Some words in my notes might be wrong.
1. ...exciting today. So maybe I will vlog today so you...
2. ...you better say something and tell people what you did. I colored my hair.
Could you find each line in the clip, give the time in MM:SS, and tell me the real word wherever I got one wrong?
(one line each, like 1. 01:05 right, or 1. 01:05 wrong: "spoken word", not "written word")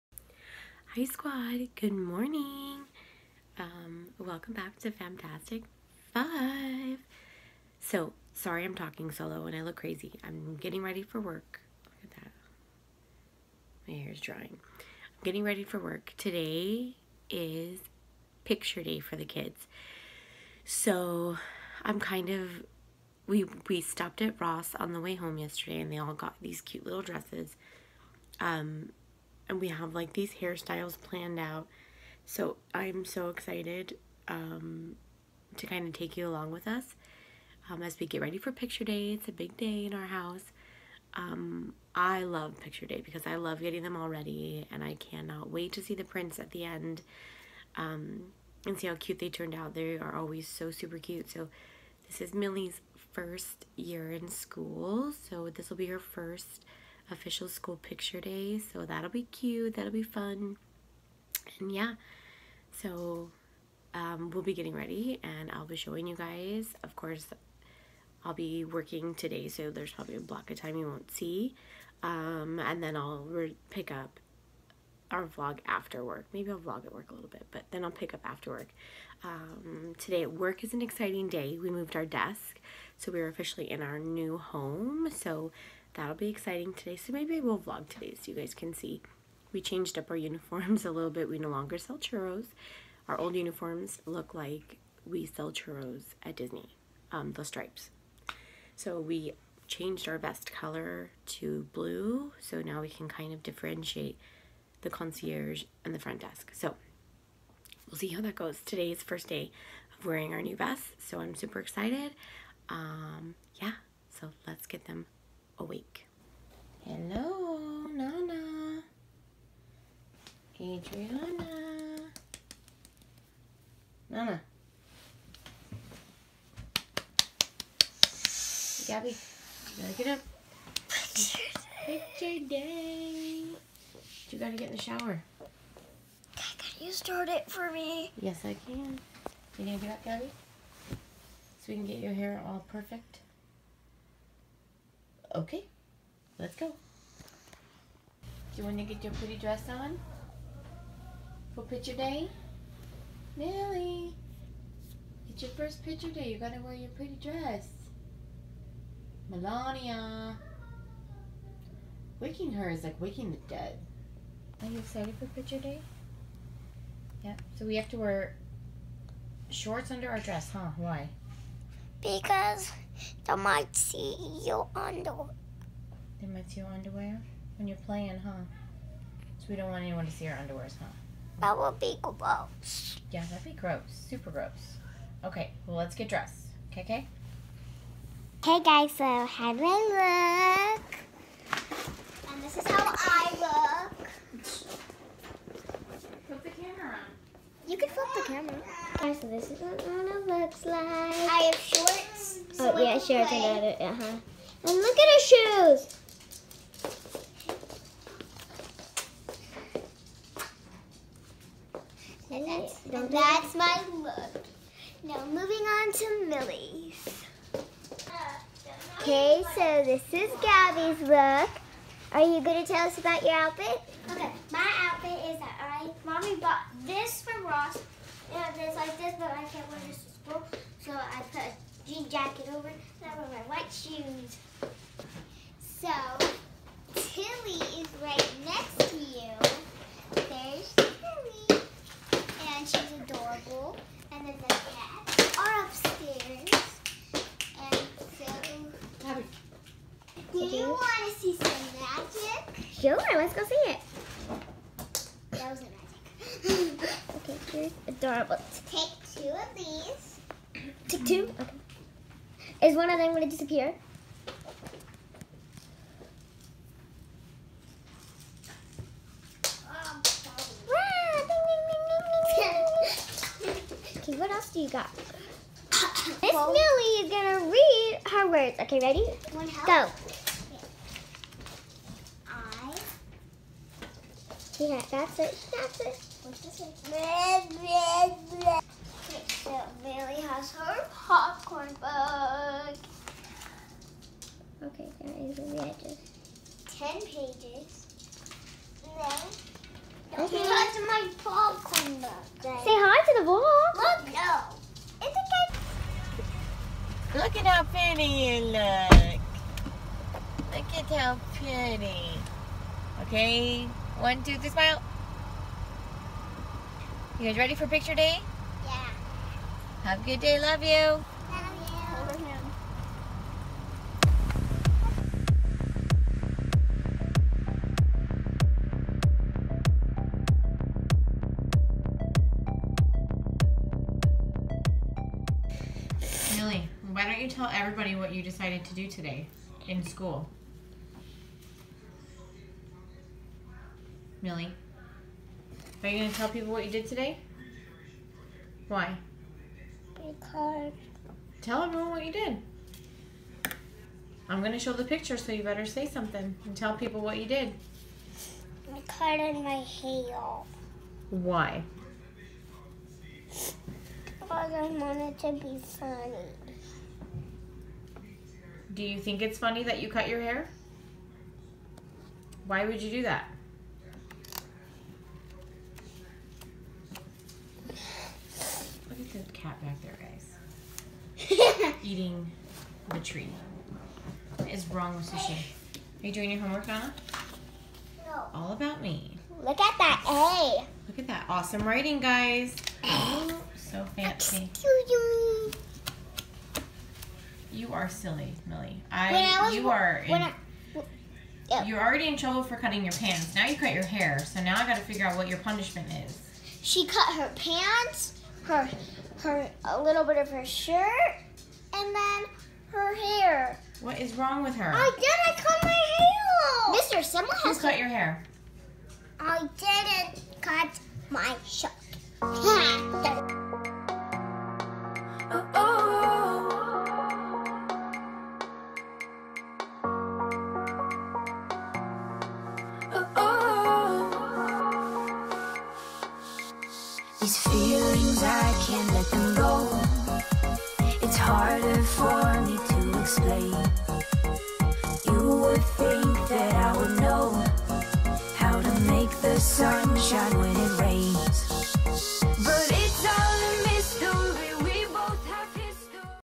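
1. 01:26 right
2. 05:55 right.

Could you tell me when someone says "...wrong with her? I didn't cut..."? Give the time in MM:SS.
06:54.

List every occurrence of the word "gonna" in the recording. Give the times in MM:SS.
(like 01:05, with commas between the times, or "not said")
02:19, 04:37.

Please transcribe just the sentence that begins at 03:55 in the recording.
So, Tilly is right next to you.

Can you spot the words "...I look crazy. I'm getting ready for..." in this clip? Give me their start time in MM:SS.
00:09.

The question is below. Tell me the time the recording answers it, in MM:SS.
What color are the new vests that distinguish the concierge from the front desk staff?
01:41.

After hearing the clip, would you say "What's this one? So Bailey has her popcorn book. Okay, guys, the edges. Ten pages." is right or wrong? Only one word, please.
right.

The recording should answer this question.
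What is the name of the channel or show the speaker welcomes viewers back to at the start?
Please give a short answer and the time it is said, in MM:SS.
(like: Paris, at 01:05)
FAMtastic Five, at 00:04.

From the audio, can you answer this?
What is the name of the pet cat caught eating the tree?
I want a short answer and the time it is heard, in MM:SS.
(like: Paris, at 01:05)
Sushi, at 06:25.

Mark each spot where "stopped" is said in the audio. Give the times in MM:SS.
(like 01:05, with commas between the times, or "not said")
00:23.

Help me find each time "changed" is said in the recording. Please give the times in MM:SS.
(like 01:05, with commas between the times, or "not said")
01:29, 01:39.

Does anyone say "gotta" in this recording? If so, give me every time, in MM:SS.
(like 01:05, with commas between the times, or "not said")
02:09, 02:14, 02:36.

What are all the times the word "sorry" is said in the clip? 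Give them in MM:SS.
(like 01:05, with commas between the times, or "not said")
00:08.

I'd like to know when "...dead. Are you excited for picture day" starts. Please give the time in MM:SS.
02:43.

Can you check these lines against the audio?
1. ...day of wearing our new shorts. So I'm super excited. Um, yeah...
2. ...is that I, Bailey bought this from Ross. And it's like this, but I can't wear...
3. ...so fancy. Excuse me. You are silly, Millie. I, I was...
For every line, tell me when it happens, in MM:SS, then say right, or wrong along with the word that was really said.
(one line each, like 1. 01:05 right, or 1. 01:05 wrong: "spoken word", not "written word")
1. 01:49 wrong: "vests", not "shorts"
2. 03:45 wrong: "Mommy", not "Bailey"
3. 06:33 right.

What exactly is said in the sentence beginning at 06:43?
Now you cut your hair, so now I got to figure out what your punishment is.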